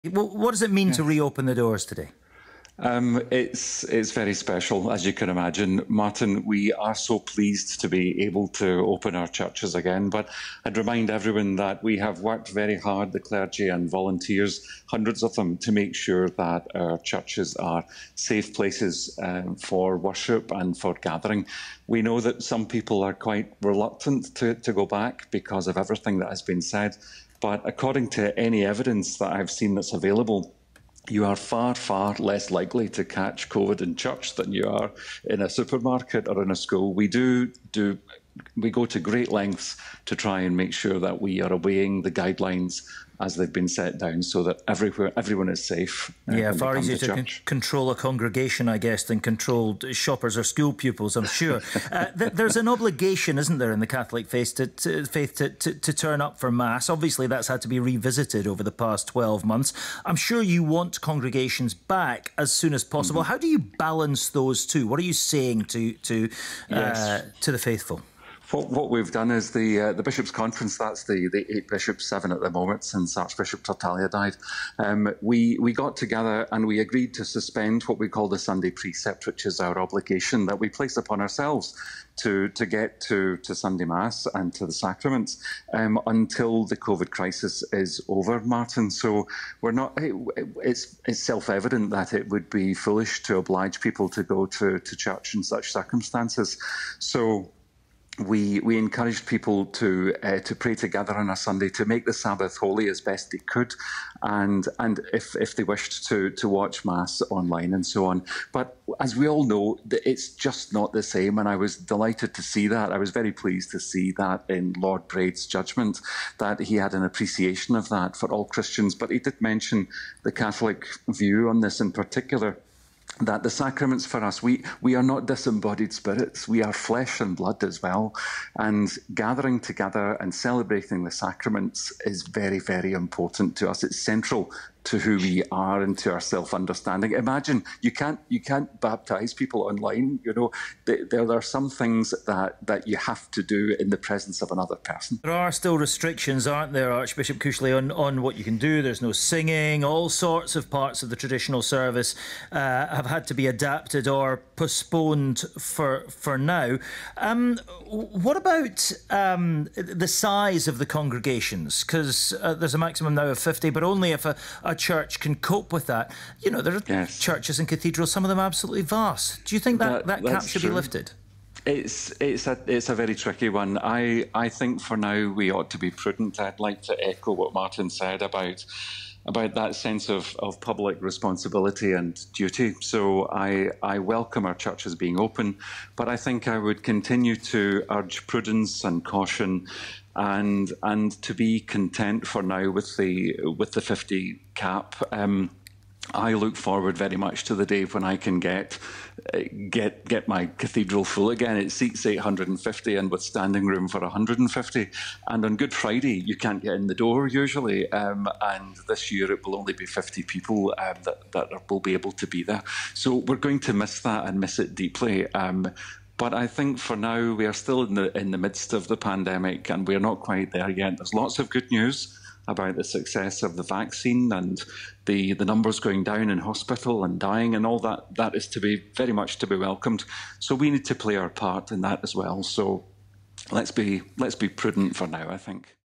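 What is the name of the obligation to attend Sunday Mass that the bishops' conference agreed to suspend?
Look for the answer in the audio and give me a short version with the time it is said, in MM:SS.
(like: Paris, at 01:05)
Sunday precept, at 01:18.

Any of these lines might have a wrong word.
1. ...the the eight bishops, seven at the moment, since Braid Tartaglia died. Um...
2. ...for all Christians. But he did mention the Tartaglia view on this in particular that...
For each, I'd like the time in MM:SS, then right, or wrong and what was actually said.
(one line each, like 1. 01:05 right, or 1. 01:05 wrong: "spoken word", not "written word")
1. 01:11 wrong: "Archbishop", not "Braid"
2. 01:58 wrong: "Catholic", not "Tartaglia".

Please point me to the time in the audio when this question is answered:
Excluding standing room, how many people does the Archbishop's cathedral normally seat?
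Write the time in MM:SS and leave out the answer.
03:22.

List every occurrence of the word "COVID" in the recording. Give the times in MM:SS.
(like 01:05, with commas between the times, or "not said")
00:33, 01:26.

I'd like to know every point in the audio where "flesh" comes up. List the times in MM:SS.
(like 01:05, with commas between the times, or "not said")
02:06.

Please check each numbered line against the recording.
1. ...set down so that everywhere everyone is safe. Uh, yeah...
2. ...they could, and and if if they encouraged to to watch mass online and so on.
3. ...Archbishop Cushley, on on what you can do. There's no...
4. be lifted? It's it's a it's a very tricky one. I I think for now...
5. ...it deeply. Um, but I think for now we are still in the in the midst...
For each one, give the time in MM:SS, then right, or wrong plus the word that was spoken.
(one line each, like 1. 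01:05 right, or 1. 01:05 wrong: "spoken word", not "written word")
1. 00:43 right
2. 01:43 wrong: "wished", not "encouraged"
3. 02:26 right
4. 02:50 right
5. 03:34 right.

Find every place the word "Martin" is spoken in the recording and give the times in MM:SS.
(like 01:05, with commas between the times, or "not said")
00:05, 01:28, 02:57.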